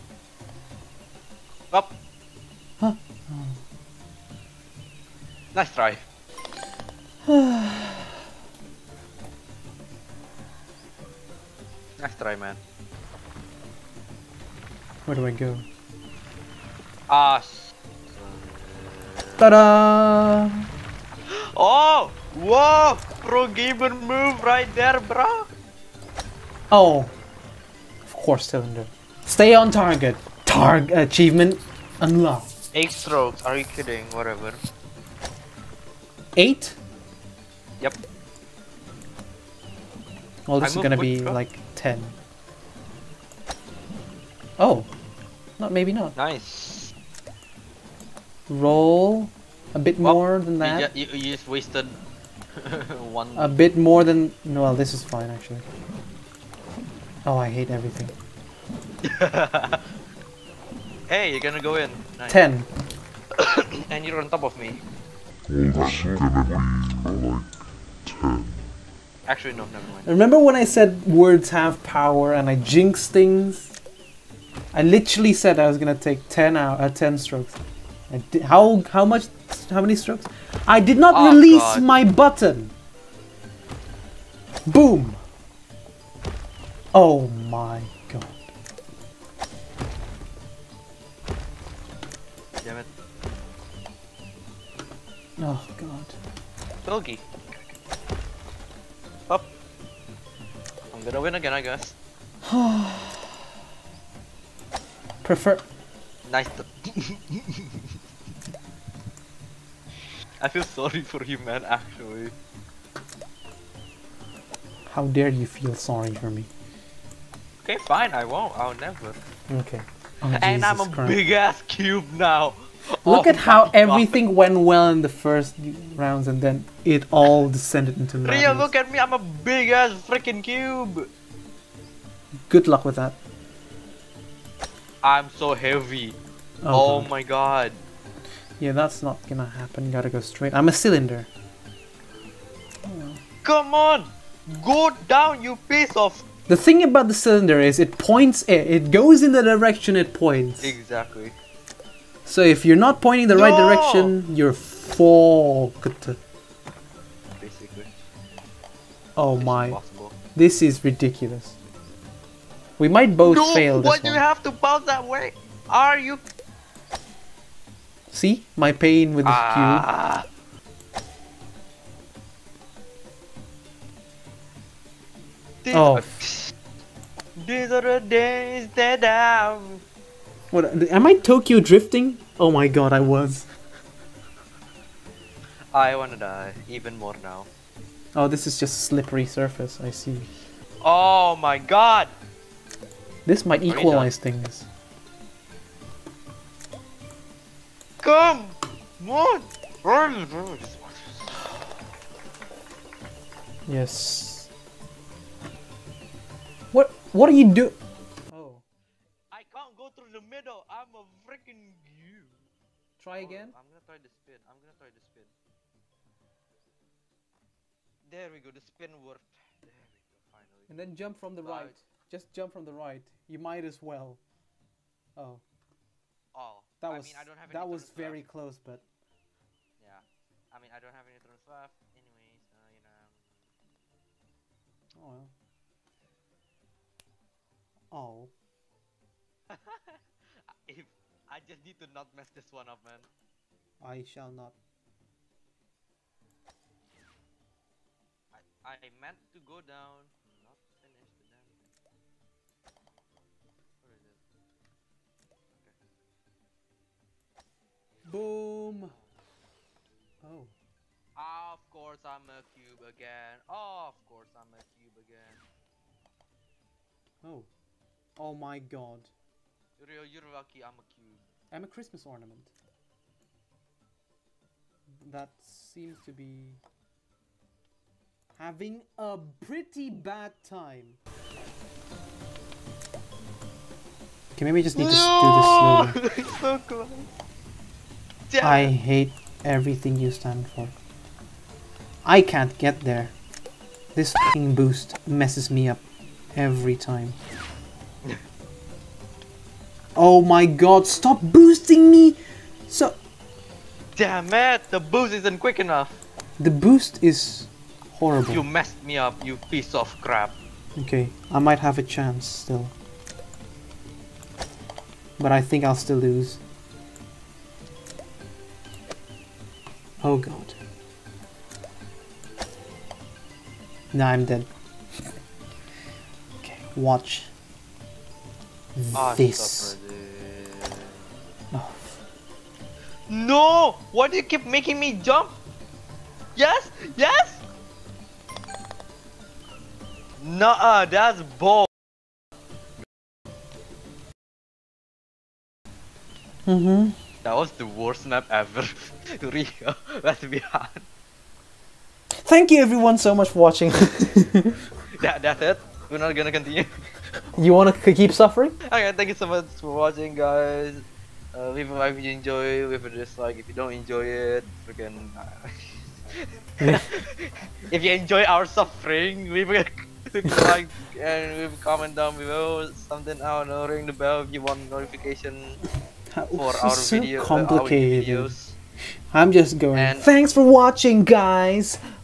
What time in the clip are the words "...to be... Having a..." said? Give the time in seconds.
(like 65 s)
276 s.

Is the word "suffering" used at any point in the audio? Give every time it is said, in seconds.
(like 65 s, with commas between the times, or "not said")
358 s, 368 s.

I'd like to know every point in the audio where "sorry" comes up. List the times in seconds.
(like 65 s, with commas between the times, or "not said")
110 s, 115 s.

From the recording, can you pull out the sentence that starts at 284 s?
Okay, maybe I just need no!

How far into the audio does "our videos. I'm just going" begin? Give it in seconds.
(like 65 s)
378 s.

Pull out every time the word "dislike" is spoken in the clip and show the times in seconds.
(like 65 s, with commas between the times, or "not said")
362 s.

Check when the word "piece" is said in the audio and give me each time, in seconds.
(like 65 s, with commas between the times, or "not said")
145 s, 309 s.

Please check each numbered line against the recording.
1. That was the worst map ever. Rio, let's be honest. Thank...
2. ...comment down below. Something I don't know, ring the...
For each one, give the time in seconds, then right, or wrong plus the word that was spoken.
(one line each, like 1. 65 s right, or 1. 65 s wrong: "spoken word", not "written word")
1. 347 s right
2. 371 s right.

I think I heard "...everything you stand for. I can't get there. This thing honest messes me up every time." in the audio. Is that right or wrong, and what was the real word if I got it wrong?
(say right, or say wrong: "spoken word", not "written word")
wrong: "boost", not "honest".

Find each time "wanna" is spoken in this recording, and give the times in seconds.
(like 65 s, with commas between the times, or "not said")
185 s, 357 s.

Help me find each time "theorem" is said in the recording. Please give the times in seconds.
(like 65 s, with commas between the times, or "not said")
not said.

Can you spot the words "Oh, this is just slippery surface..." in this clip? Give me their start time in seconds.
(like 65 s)
188 s.